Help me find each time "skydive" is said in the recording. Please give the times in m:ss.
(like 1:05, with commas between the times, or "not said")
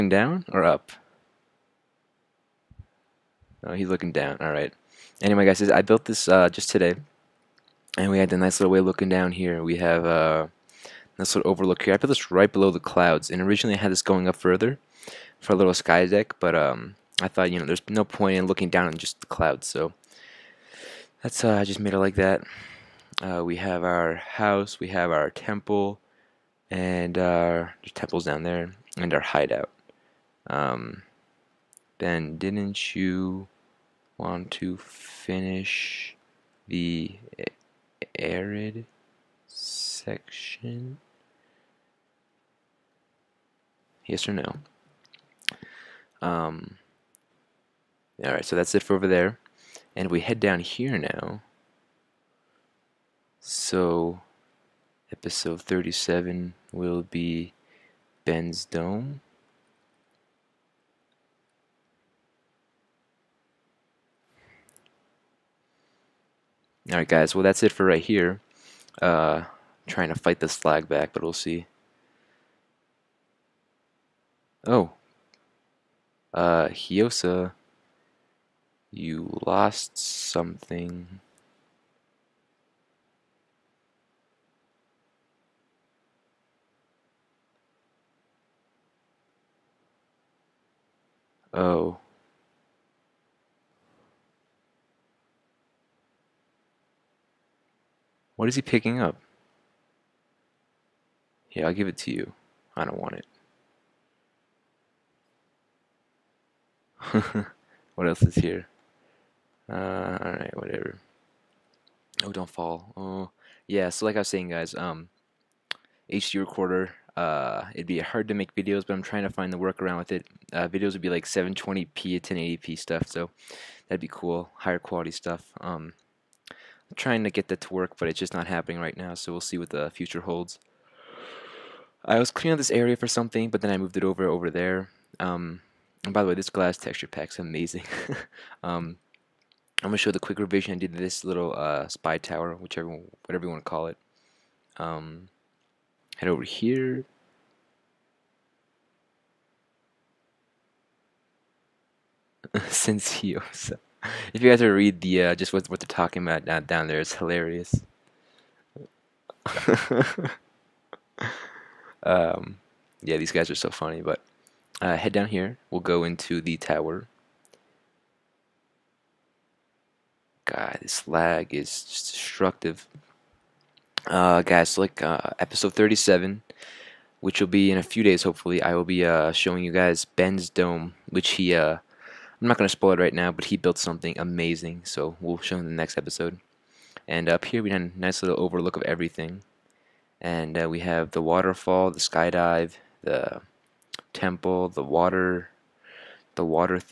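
3:11.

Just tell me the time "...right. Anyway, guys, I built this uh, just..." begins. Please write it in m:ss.
0:04.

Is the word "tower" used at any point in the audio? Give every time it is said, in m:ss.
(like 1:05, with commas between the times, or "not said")
2:22, 2:46.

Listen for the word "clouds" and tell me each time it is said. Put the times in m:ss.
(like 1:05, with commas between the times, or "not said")
0:12, 0:19.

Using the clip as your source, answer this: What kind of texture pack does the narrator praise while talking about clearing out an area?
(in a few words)
Glass texture pack.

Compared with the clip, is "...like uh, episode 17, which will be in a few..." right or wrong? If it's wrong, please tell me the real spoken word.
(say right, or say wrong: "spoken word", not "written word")
wrong: "37", not "17".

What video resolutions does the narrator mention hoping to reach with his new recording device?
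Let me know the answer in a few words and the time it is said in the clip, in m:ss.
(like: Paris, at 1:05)
720p, 1080p, at 2:01.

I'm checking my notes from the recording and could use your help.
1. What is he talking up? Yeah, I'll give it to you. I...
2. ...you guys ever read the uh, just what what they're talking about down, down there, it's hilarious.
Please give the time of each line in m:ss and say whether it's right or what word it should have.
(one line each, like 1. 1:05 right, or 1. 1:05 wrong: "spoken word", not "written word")
1. 1:38 wrong: "picking", not "talking"
2. 2:34 right.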